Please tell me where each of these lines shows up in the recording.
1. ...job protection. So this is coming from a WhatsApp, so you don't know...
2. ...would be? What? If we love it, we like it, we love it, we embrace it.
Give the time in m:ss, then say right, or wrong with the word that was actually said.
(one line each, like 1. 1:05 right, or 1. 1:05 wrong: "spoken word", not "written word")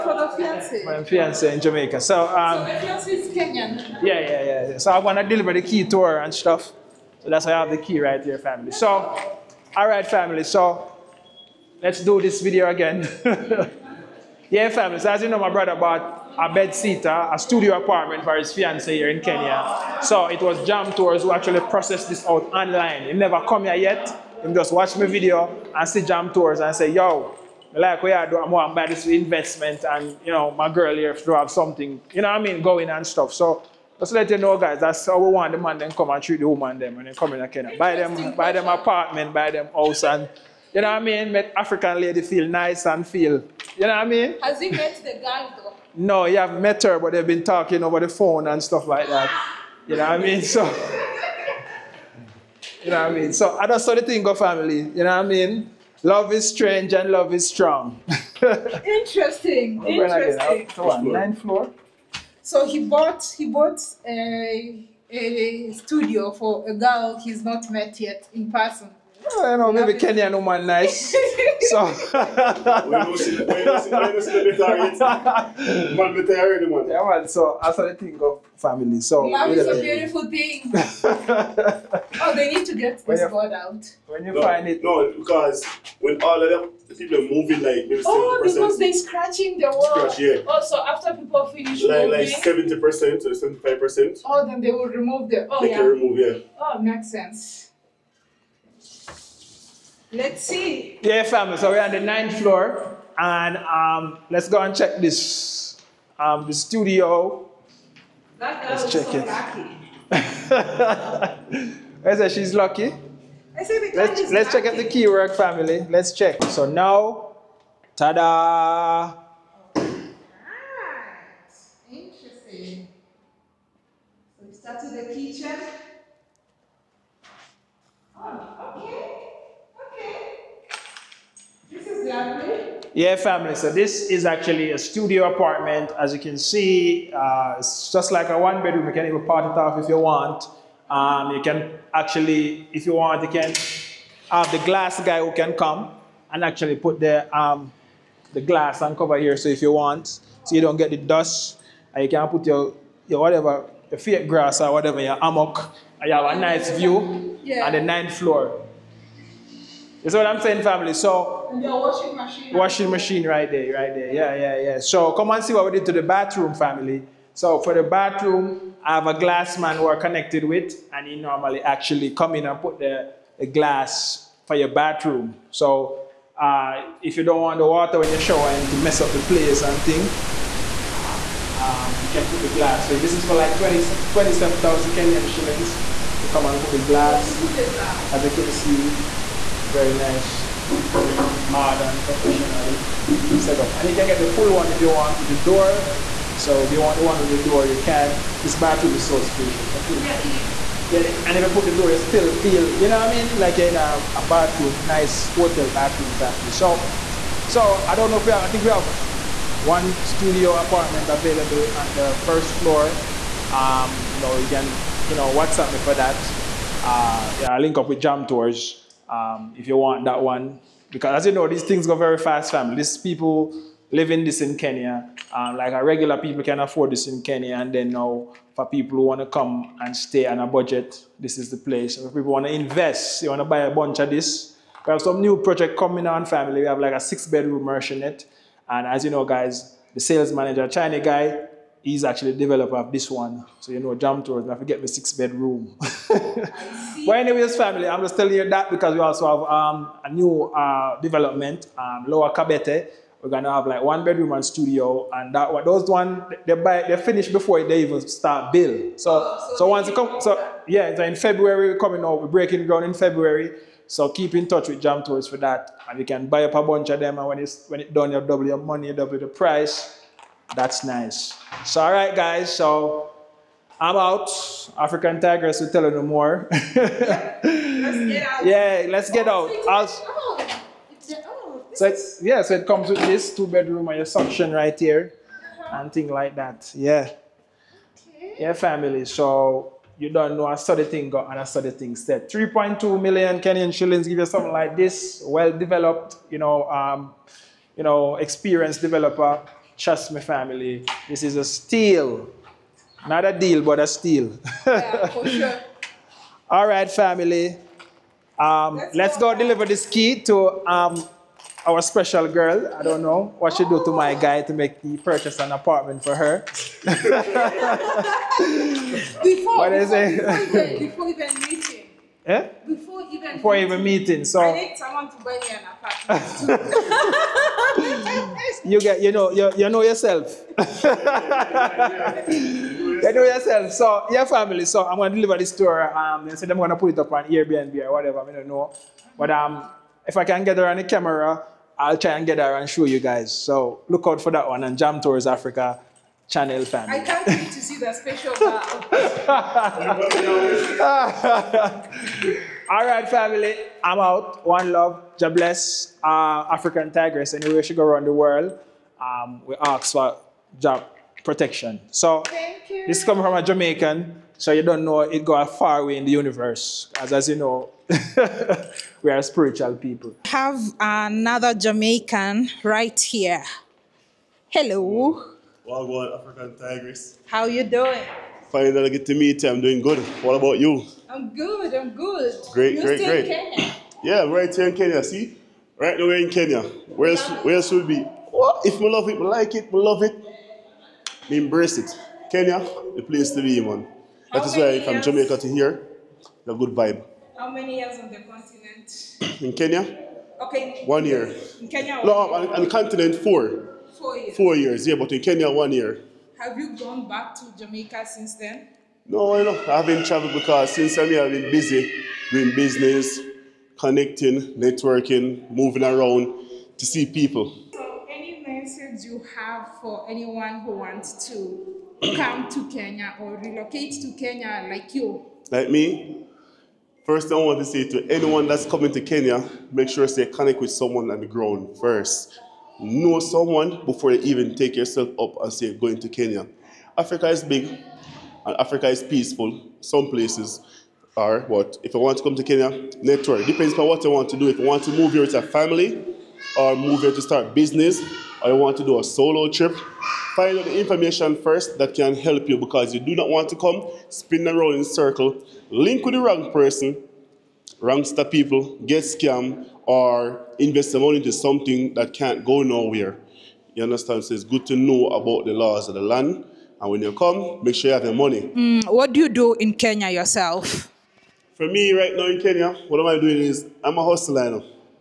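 1. 6:00 wrong: "Jamaican", not "WhatsApp"
2. 6:27 right.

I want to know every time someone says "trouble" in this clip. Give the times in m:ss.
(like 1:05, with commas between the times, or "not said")
not said.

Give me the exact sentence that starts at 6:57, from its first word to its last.
So, any message you have for anyone who wants to come to Kenya or relocate to Kenya like you?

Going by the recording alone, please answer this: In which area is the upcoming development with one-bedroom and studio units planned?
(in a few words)
Lower Kabete.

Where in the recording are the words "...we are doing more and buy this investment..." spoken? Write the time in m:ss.
0:28.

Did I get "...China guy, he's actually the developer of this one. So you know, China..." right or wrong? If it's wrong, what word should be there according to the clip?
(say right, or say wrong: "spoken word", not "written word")
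wrong: "Jam", not "China".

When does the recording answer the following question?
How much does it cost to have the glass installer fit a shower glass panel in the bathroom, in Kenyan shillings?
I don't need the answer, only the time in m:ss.
3:04.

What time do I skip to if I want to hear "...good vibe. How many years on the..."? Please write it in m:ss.
6:36.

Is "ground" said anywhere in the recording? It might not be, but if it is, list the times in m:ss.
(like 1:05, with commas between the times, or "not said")
4:22, 7:11.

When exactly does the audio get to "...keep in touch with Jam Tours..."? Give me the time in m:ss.
4:24.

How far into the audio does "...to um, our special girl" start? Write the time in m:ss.
5:10.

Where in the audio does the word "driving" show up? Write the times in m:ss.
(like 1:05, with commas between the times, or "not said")
not said.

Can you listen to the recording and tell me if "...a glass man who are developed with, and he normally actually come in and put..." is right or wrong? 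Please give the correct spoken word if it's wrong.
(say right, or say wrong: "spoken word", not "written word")
wrong: "connected", not "developed".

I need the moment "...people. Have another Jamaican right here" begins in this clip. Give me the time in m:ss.
6:09.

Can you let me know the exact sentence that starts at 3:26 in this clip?
So so I don't know if we have, I think we have one studio apartment available on the first floor.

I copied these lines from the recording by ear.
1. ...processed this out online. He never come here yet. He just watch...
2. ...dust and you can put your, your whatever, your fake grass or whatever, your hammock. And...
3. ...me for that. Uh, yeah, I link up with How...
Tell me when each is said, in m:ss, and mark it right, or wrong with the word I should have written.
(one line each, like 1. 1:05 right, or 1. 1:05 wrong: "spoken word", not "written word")
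1. 0:21 right
2. 2:30 right
3. 3:35 wrong: "Jam", not "How".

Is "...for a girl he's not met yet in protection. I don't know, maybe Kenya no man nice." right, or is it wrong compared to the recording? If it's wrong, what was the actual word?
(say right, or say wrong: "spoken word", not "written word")
wrong: "person", not "protection".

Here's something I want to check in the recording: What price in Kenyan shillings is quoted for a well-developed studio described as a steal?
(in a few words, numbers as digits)
3.2 million.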